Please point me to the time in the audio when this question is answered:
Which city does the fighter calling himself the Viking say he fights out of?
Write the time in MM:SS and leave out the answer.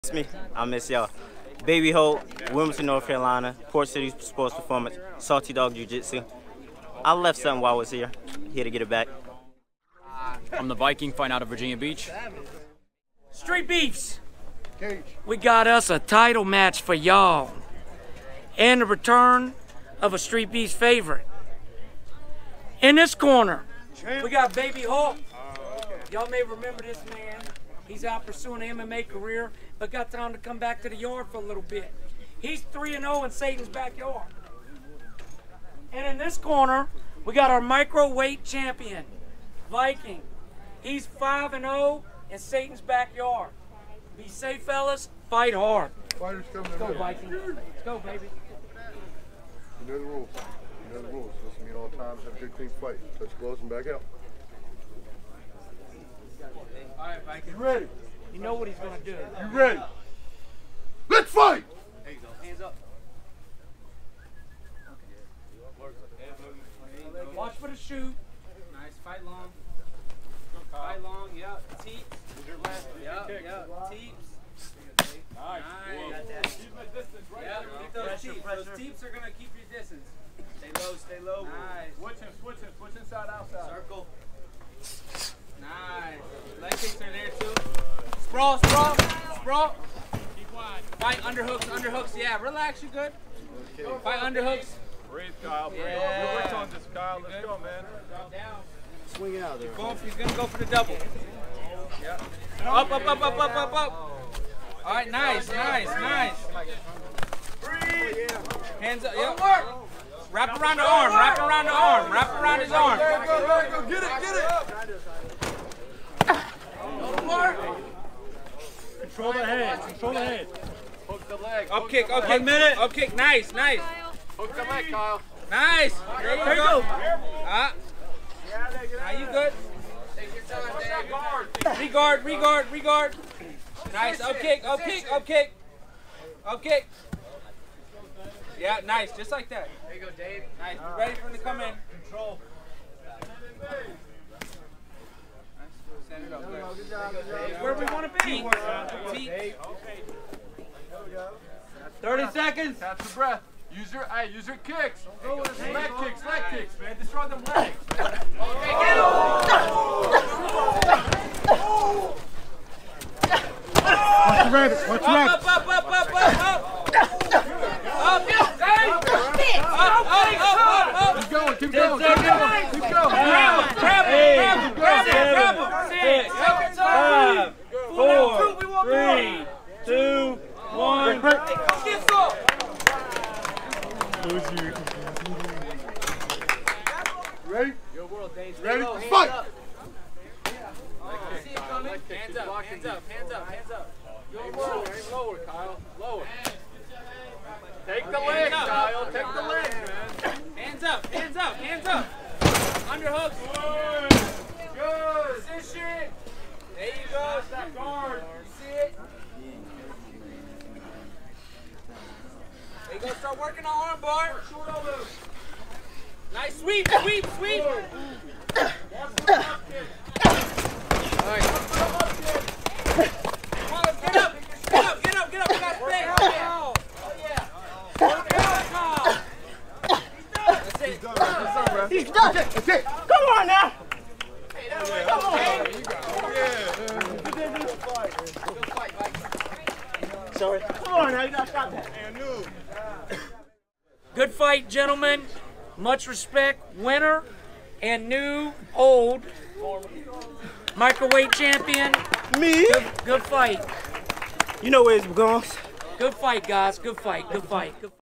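00:11.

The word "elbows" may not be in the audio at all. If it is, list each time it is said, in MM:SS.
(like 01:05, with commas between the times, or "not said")
03:34.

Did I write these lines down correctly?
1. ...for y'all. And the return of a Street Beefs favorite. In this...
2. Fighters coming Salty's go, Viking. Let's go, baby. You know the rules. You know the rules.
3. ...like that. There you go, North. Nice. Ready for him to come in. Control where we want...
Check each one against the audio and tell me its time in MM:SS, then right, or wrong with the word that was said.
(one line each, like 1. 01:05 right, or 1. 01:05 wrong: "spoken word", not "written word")
1. 00:16 right
2. 00:46 wrong: "Let", not "Salty"
3. 02:19 wrong: "Dave", not "North".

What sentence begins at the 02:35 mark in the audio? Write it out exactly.
Go with his leg kicks, leg kicks, man.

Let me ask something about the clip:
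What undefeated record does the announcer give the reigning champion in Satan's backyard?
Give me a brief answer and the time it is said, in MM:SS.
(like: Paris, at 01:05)
5-0, at 00:41.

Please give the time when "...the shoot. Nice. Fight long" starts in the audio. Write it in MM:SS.
01:07.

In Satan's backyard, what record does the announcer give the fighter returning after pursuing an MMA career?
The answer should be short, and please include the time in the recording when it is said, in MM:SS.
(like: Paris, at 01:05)
3-0, at 00:32.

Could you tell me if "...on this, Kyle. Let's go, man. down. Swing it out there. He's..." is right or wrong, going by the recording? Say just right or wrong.
right.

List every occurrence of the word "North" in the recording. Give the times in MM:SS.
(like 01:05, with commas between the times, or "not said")
00:02.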